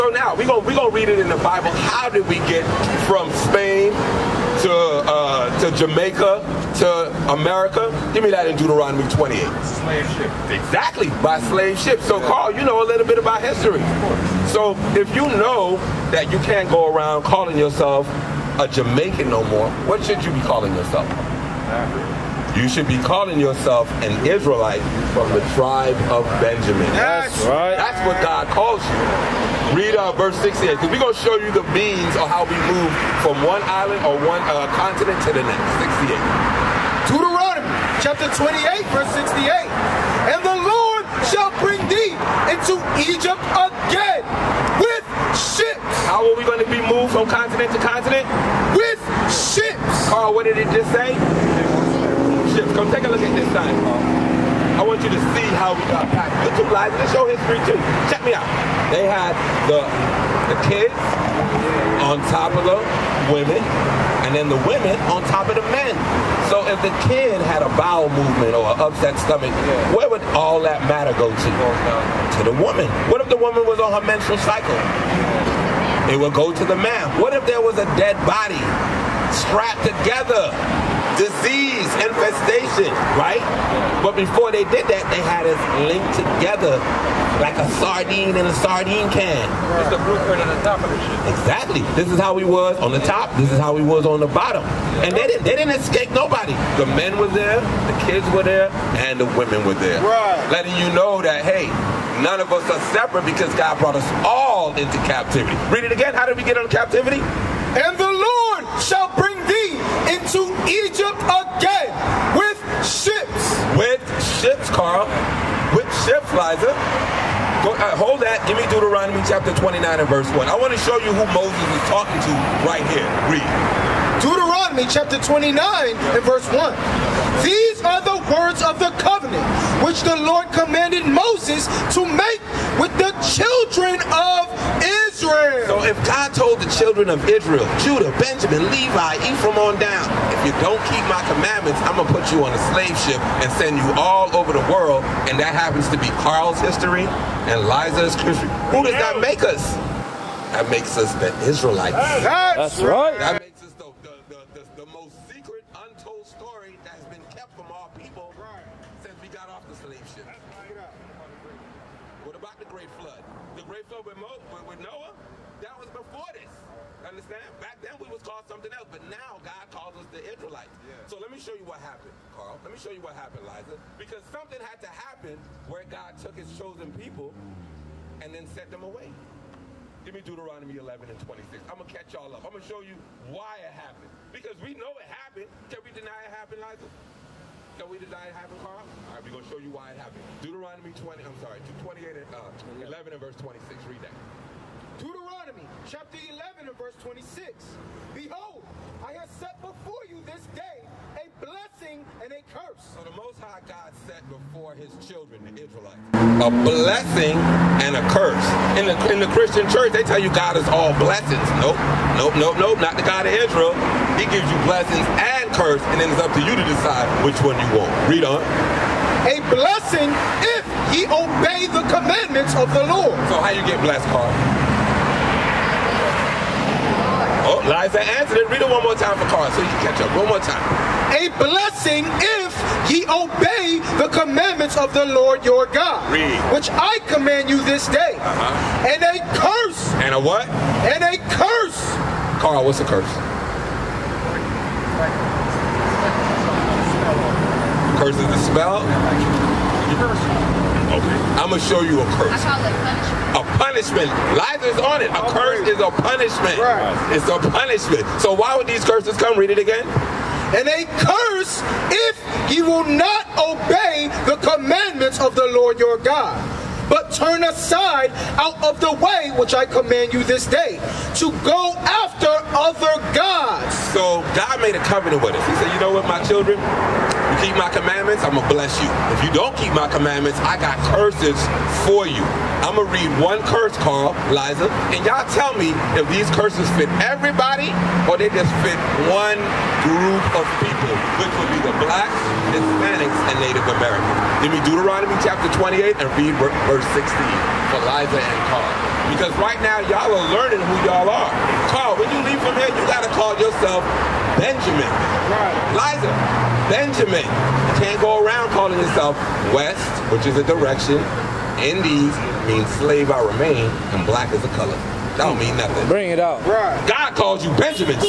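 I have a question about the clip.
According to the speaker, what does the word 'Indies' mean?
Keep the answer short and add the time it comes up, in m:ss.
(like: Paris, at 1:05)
Slave I remain, at 5:11.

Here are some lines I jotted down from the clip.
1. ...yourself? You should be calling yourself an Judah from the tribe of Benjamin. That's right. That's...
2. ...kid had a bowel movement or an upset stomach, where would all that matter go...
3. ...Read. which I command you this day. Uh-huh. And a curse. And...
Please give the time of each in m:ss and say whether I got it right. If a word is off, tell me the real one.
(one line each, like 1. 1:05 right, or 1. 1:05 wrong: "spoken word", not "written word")
1. 0:20 wrong: "Israelite", not "Judah"
2. 1:07 right
3. 3:56 right.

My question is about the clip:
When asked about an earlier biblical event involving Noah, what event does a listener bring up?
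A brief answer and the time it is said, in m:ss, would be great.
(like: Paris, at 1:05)
The Great Flood, at 2:42.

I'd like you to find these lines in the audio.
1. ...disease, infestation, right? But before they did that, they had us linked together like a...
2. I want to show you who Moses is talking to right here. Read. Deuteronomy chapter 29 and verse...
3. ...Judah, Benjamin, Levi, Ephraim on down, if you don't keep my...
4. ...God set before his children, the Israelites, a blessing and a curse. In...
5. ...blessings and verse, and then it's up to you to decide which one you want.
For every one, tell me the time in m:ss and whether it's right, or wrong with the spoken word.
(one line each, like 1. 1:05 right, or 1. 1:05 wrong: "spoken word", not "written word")
1. 1:21 right
2. 2:00 right
3. 2:17 right
4. 3:23 right
5. 3:34 wrong: "curse", not "verse".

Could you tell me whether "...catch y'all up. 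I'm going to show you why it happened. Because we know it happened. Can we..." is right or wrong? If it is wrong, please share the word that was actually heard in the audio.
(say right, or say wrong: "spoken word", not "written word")
right.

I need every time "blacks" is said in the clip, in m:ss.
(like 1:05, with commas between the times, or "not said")
4:51, 5:14.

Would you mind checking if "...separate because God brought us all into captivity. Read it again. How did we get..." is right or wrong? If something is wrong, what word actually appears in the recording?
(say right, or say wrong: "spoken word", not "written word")
right.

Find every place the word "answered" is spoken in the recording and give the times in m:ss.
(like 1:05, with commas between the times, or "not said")
3:48.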